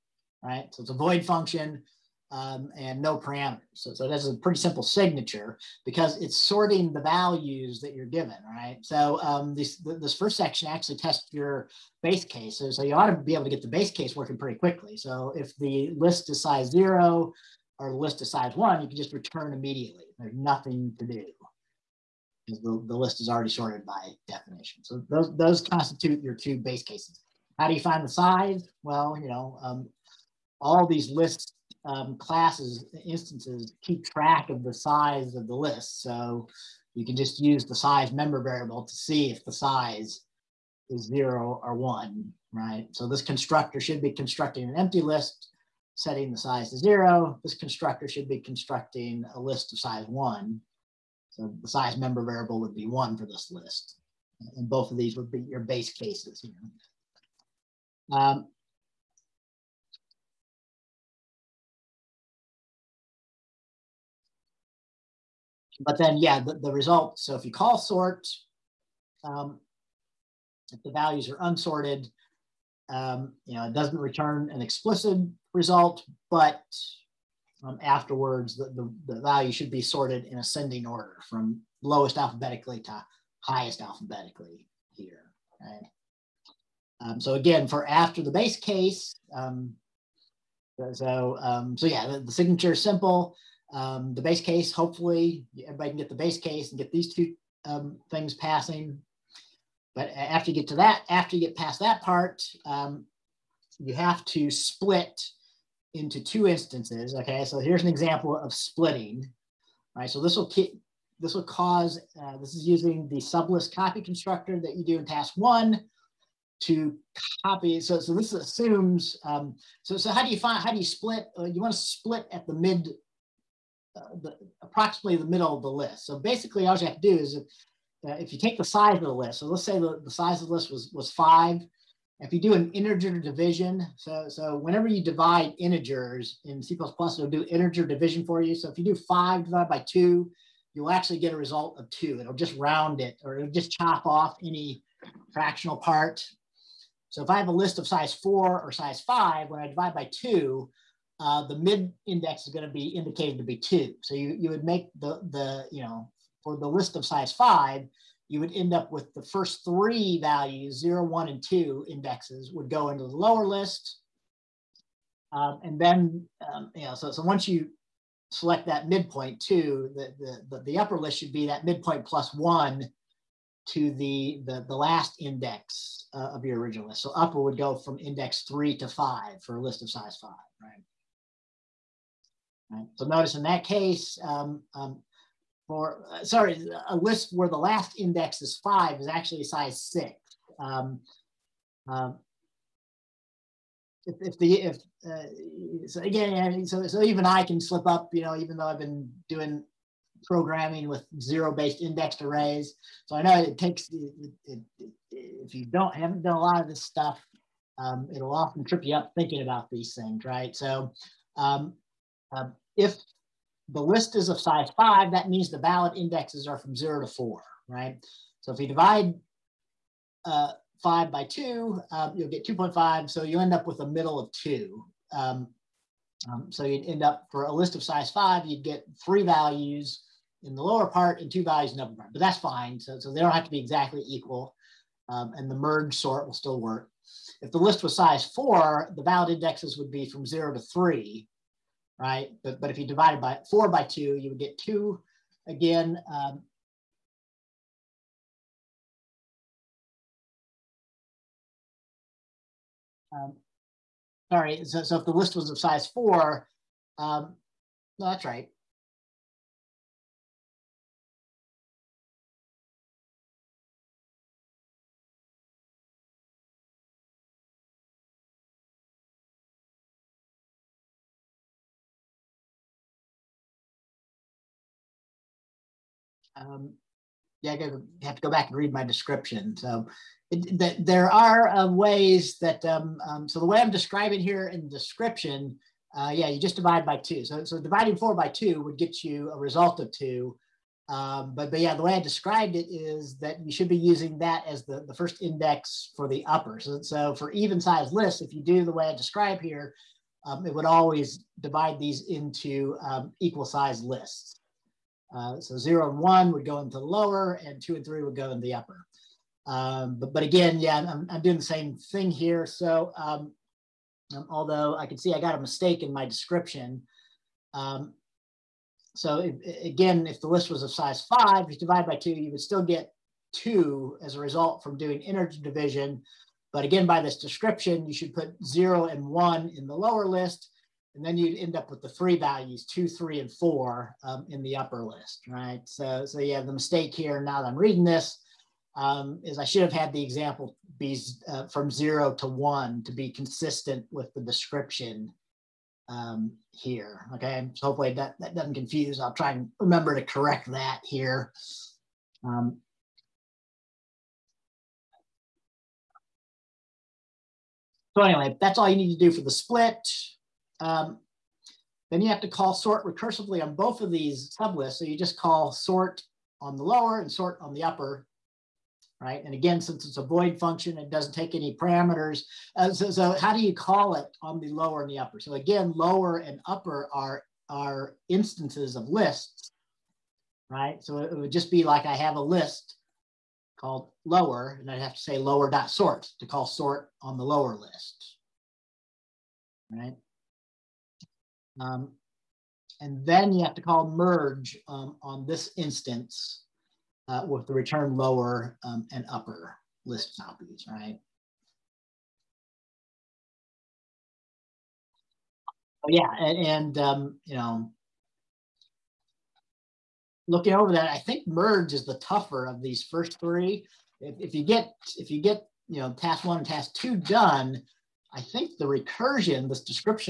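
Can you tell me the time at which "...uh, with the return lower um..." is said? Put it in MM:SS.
06:37.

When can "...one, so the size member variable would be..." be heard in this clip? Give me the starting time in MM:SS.
00:50.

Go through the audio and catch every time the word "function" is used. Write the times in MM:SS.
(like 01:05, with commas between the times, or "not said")
00:01, 06:10.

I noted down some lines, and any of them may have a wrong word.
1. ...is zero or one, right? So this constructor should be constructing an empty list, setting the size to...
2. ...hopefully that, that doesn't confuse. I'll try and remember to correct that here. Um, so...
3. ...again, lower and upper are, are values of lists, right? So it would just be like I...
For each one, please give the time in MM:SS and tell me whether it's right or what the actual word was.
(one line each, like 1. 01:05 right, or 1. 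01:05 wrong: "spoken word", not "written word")
1. 00:40 right
2. 05:47 right
3. 06:15 wrong: "instances", not "values".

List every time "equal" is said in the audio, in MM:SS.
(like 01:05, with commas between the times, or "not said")
03:54, 05:03.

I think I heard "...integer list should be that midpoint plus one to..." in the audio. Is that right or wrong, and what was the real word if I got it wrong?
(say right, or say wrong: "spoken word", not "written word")
wrong: "upper", not "integer".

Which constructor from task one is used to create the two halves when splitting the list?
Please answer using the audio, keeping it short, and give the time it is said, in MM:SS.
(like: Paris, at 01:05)
sublist copy constructor, at 01:53.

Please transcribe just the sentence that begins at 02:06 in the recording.
So basically, all you have to do is if, uh, if you take the size of the list.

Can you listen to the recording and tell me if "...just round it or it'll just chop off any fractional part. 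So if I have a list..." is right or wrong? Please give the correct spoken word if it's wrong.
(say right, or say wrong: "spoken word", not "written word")
right.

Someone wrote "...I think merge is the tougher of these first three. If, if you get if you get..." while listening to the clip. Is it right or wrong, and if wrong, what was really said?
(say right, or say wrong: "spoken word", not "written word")
right.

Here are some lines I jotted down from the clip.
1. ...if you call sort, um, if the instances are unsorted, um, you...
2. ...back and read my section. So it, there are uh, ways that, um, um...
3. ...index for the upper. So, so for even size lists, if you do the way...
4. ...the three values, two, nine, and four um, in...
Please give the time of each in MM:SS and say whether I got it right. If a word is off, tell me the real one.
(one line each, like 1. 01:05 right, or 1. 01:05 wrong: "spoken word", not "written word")
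1. 01:07 wrong: "values", not "instances"
2. 04:38 wrong: "description", not "section"
3. 04:55 right
4. 05:31 wrong: "three", not "nine".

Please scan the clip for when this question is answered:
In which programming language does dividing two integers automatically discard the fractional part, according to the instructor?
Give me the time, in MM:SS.
02:16.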